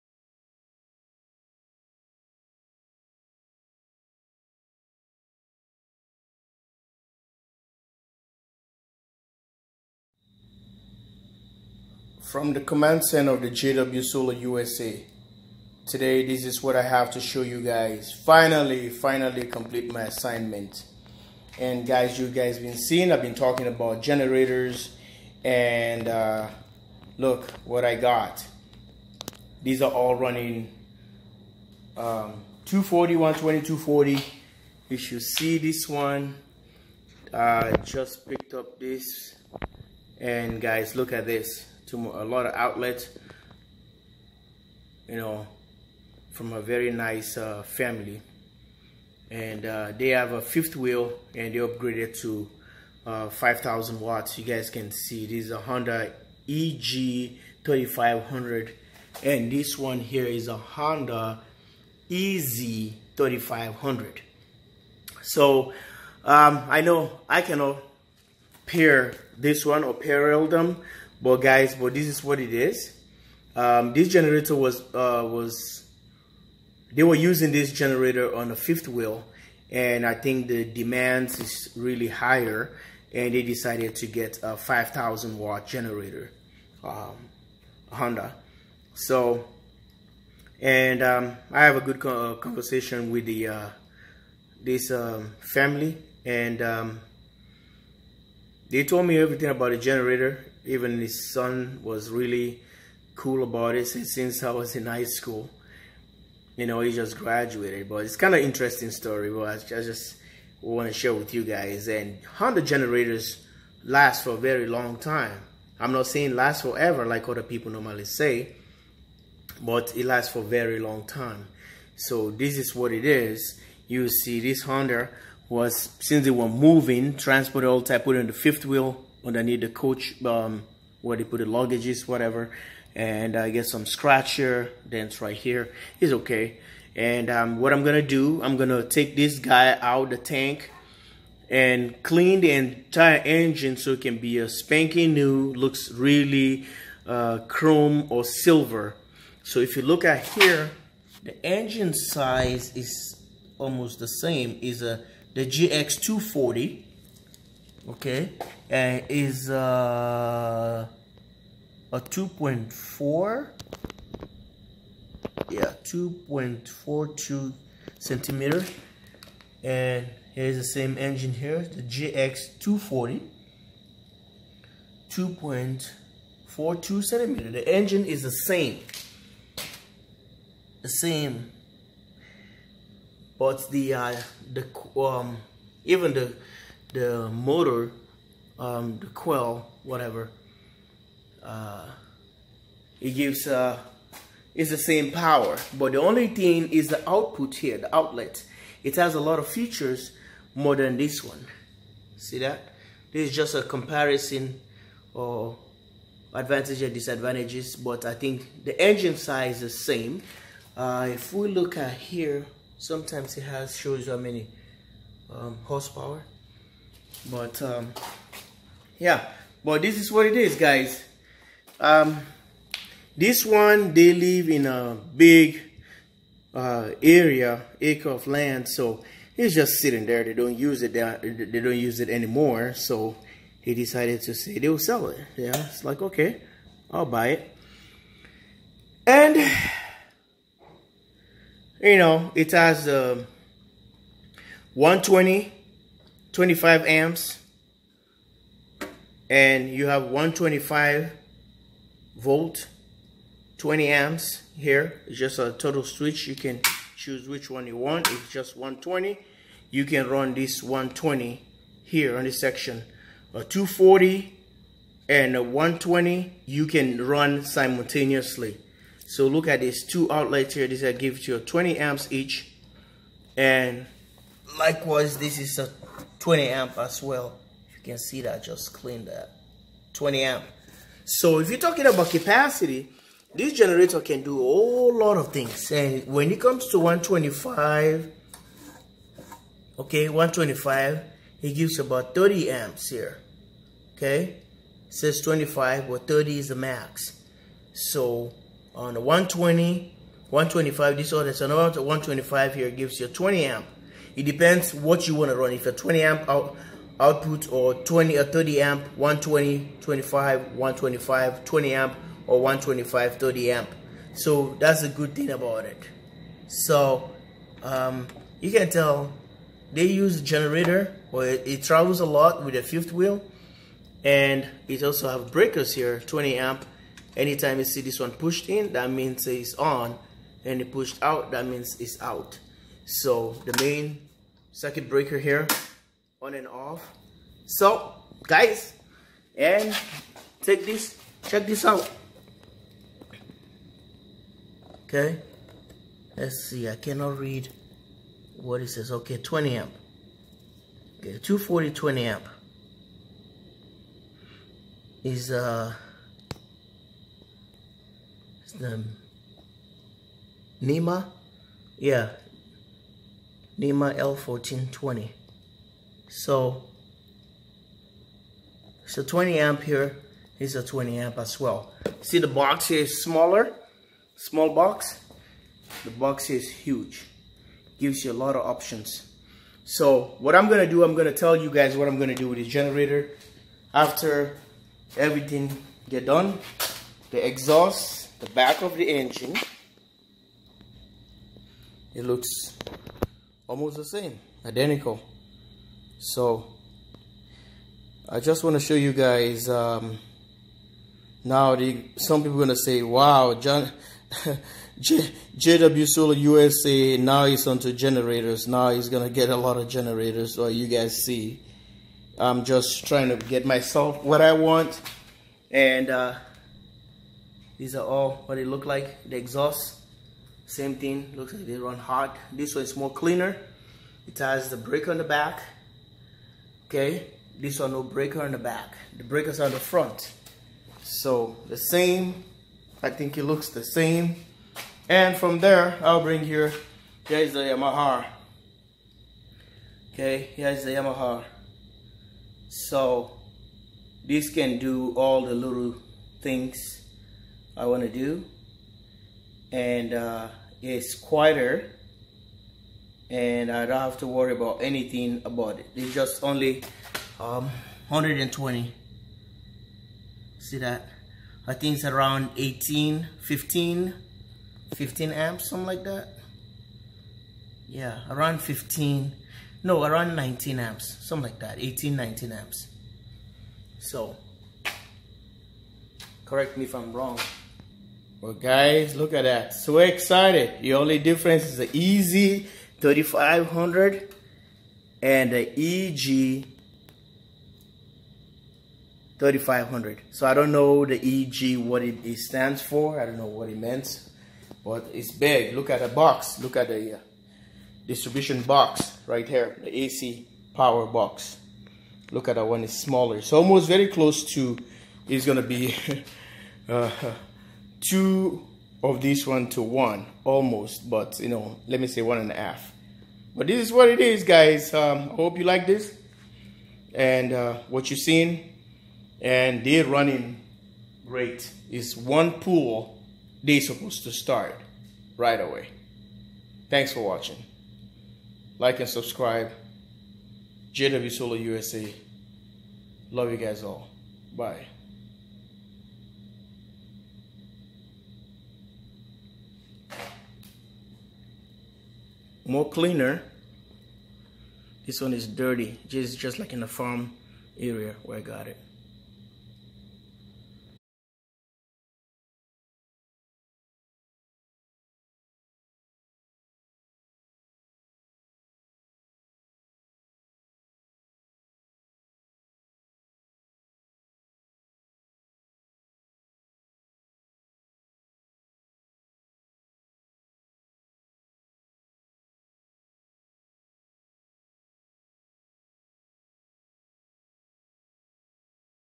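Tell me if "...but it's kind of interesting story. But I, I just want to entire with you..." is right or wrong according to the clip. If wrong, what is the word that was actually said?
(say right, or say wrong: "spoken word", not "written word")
wrong: "share", not "entire".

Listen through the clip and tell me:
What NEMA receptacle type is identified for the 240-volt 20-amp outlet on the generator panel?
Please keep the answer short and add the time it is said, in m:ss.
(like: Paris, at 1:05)
L1420, at 6:03.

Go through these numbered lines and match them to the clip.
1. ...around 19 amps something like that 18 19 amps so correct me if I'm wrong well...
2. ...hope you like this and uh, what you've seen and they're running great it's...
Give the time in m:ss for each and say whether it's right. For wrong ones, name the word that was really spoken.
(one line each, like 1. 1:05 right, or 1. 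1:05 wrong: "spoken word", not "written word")
1. 7:49 right
2. 8:35 right.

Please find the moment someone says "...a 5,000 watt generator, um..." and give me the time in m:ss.
1:24.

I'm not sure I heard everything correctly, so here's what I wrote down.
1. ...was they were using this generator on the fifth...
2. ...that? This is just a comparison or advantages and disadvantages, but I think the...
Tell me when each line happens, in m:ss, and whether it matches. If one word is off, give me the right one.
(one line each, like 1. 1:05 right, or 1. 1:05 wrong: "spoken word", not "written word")
1. 1:15 right
2. 3:22 right.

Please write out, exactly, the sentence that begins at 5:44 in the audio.
Okay, let's see, I cannot read what it says.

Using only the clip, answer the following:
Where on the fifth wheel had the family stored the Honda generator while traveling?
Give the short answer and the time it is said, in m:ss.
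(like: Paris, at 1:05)
underneath the coach, at 2:09.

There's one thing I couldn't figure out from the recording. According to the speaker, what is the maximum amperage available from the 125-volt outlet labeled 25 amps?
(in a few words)
30 amps.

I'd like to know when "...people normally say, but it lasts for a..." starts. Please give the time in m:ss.
1:57.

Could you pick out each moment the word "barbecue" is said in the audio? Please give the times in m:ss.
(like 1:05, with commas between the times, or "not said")
not said.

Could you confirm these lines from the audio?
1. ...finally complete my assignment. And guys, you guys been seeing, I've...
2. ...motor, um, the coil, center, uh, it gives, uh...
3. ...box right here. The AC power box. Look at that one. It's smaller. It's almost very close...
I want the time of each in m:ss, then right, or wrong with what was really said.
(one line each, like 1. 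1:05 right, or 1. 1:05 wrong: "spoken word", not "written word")
1. 0:18 right
2. 3:07 wrong: "whatever", not "center"
3. 8:18 right.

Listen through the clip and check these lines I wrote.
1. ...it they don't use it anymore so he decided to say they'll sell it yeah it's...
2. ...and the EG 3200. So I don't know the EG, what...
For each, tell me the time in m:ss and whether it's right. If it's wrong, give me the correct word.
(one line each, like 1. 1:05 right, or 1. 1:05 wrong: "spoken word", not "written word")
1. 3:50 right
2. 8:05 wrong: "3500", not "3200".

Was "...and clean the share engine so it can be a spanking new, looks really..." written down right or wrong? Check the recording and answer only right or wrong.
wrong.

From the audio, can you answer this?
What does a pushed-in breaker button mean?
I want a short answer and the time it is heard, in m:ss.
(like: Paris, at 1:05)
it's on, at 5:28.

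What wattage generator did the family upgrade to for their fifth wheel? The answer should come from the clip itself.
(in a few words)
5,000 watts.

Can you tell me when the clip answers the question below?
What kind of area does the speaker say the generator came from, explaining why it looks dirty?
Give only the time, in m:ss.
9:06.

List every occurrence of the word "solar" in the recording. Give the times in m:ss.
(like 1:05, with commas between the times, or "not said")
0:14, 6:45, 8:51.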